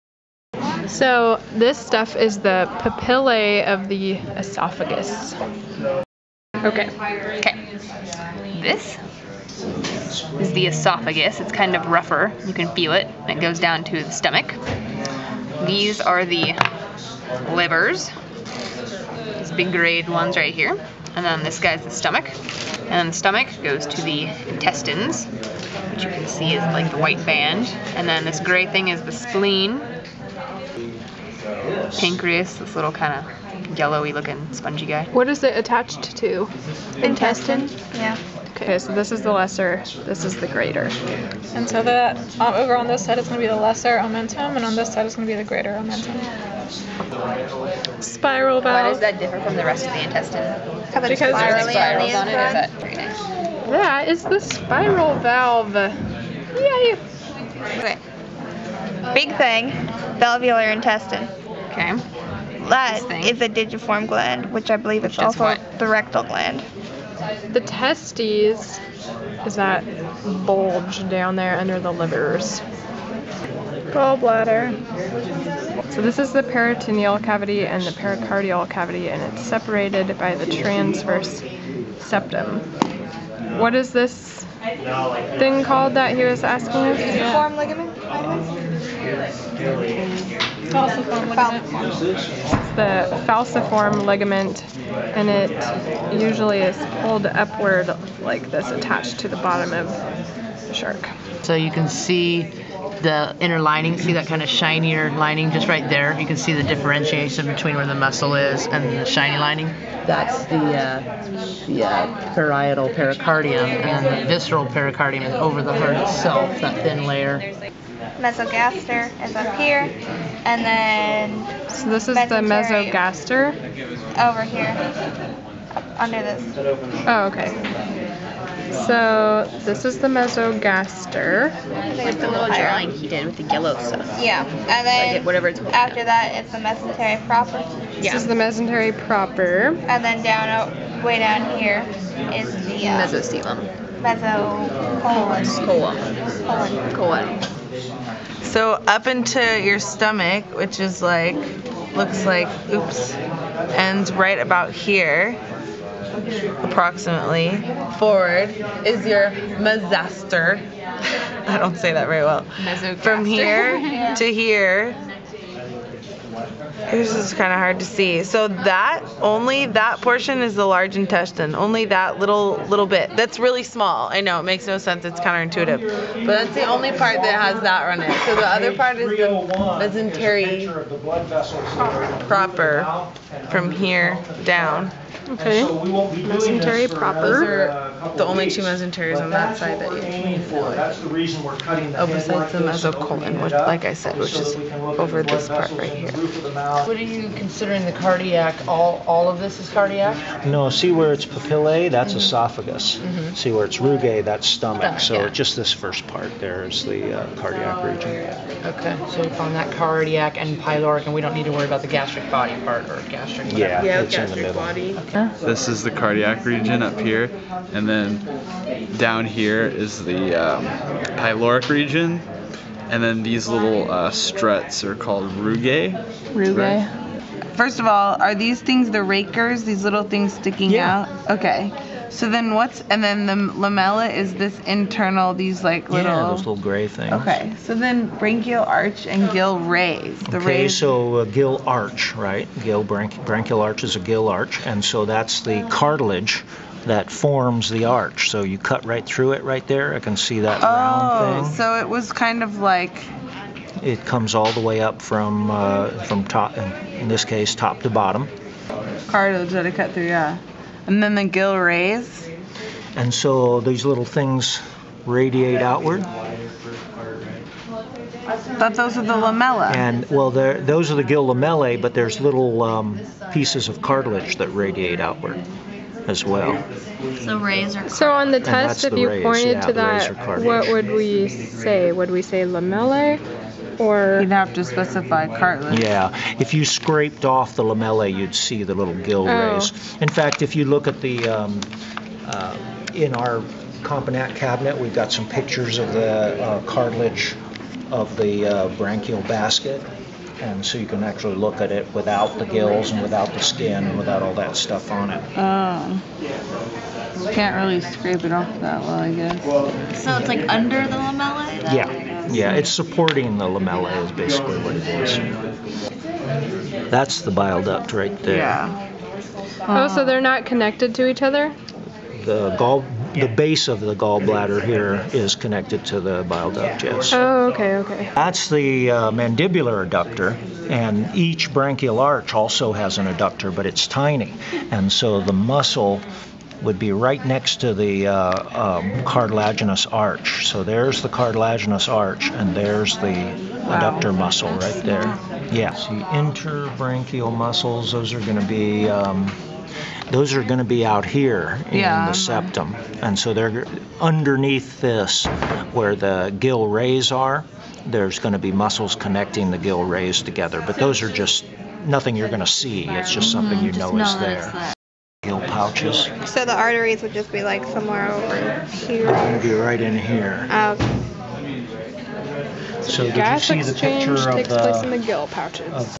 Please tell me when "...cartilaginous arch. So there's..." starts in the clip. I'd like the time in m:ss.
5:39.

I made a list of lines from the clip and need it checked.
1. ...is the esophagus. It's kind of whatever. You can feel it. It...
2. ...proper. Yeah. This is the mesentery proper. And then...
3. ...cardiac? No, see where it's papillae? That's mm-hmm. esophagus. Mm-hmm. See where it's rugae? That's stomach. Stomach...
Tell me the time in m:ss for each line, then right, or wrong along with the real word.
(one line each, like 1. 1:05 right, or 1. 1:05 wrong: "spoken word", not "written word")
1. 0:10 wrong: "rougher", not "whatever"
2. 2:17 right
3. 3:19 right.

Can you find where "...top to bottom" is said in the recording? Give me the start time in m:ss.
4:17.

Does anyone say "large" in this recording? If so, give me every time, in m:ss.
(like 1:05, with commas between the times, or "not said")
2:50.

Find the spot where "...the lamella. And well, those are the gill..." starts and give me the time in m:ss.
4:29.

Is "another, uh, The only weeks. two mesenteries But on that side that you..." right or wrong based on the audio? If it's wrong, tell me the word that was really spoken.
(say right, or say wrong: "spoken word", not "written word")
right.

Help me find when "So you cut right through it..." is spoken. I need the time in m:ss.
4:08.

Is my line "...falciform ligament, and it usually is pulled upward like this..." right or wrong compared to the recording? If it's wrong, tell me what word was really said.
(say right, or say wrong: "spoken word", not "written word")
right.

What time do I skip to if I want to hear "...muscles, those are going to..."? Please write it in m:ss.
5:47.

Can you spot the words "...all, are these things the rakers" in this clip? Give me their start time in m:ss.
3:47.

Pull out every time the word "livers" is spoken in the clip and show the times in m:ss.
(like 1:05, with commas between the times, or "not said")
0:17, 1:11.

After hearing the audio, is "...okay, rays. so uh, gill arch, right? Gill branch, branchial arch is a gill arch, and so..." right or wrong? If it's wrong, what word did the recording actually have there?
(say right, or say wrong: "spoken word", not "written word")
right.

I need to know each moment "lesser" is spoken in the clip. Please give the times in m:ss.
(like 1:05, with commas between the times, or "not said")
0:39, 0:43.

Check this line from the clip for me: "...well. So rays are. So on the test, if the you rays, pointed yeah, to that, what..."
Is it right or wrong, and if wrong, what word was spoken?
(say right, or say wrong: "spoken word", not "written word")
right.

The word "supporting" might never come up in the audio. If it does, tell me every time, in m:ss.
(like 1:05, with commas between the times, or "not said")
5:12.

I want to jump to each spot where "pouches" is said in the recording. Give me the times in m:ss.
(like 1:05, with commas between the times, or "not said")
6:05, 6:15.